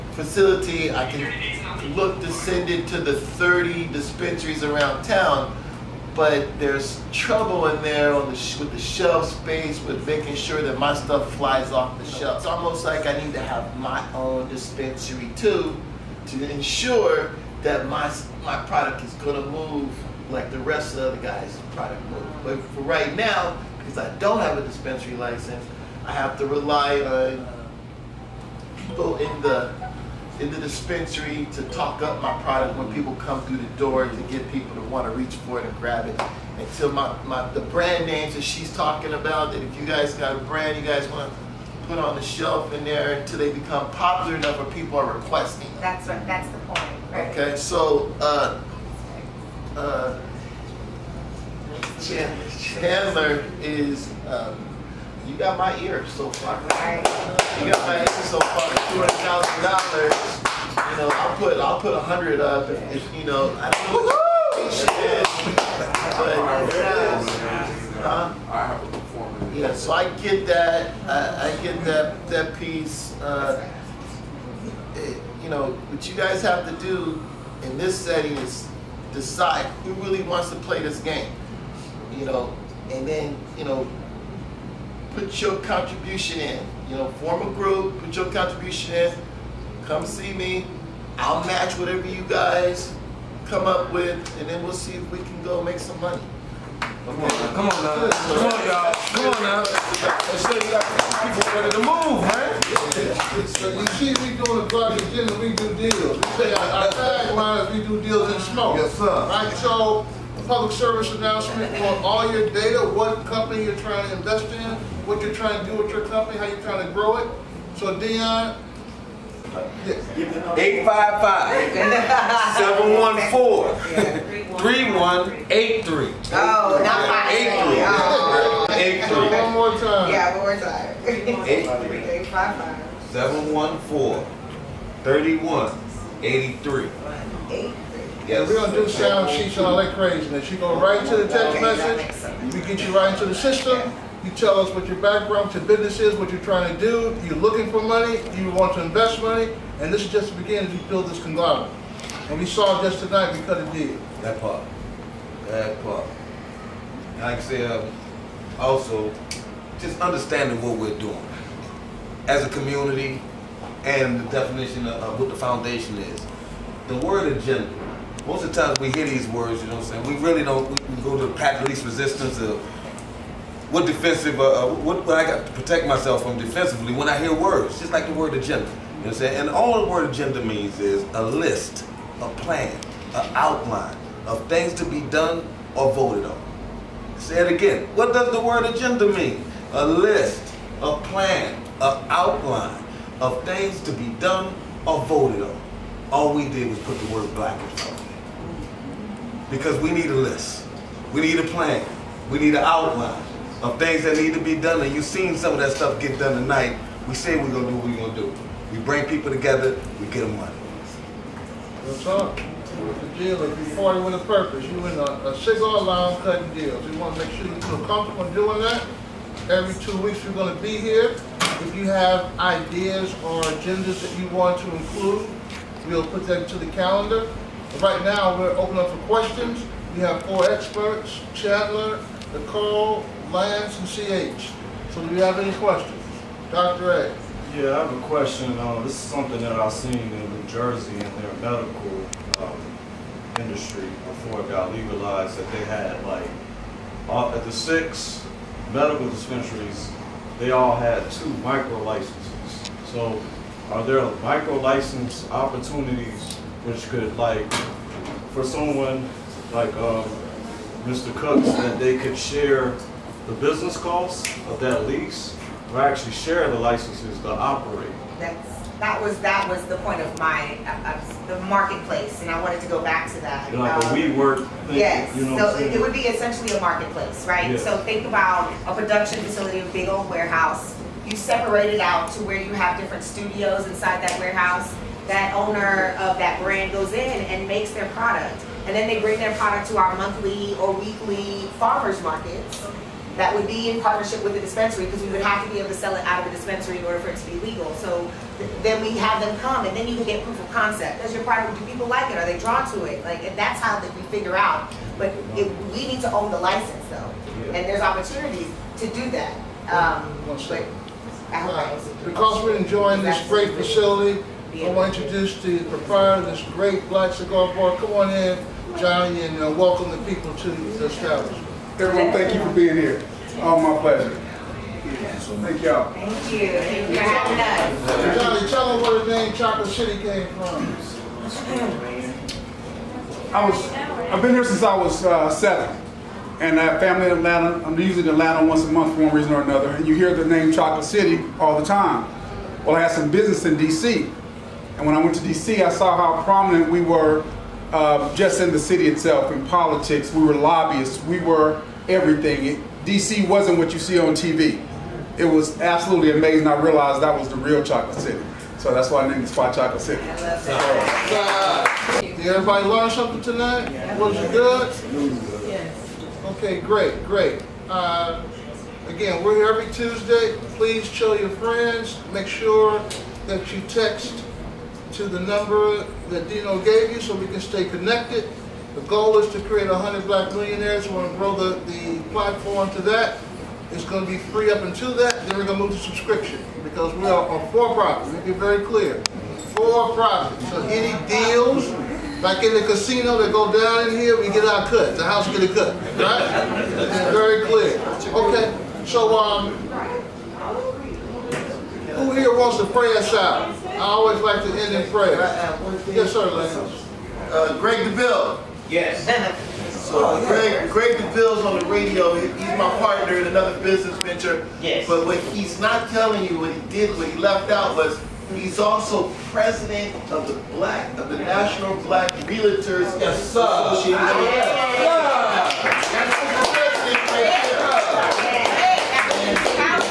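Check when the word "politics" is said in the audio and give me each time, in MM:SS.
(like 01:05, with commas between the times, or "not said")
05:49.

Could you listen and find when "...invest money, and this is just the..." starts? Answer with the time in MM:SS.
02:28.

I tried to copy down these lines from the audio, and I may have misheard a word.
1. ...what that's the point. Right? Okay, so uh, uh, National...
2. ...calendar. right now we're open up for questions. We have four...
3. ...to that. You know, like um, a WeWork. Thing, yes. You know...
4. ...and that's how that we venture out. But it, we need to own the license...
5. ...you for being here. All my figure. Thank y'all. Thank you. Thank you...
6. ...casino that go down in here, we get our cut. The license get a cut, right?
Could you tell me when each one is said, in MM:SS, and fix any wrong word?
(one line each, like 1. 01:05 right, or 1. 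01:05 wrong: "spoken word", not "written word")
1. 00:46 wrong: "Chandler", not "National"
2. 03:46 right
3. 04:33 right
4. 05:03 wrong: "figure", not "venture"
5. 05:22 wrong: "pleasure", not "figure"
6. 06:32 wrong: "house", not "license".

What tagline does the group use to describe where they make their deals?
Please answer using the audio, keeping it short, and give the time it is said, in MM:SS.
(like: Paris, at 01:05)
We do deals in smoke, at 01:47.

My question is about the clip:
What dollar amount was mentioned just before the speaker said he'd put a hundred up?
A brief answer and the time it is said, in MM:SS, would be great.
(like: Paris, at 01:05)
$200,000, at 00:58.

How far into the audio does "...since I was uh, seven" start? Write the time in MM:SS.
05:34.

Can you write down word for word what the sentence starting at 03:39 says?
Every two weeks we're going to be here.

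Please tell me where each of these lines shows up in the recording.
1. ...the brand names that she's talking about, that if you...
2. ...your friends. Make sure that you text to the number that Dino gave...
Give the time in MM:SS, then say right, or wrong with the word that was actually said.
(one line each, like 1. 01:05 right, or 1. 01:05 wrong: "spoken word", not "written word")
1. 00:37 right
2. 06:11 right.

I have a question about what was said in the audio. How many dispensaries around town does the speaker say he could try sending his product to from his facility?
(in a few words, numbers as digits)
30.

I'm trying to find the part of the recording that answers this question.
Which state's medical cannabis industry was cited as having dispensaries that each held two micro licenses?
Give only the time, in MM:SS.
04:00.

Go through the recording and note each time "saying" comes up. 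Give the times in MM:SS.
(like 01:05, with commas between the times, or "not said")
02:50, 02:59.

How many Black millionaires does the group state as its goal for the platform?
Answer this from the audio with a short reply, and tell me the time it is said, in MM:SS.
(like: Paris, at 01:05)
100, at 06:19.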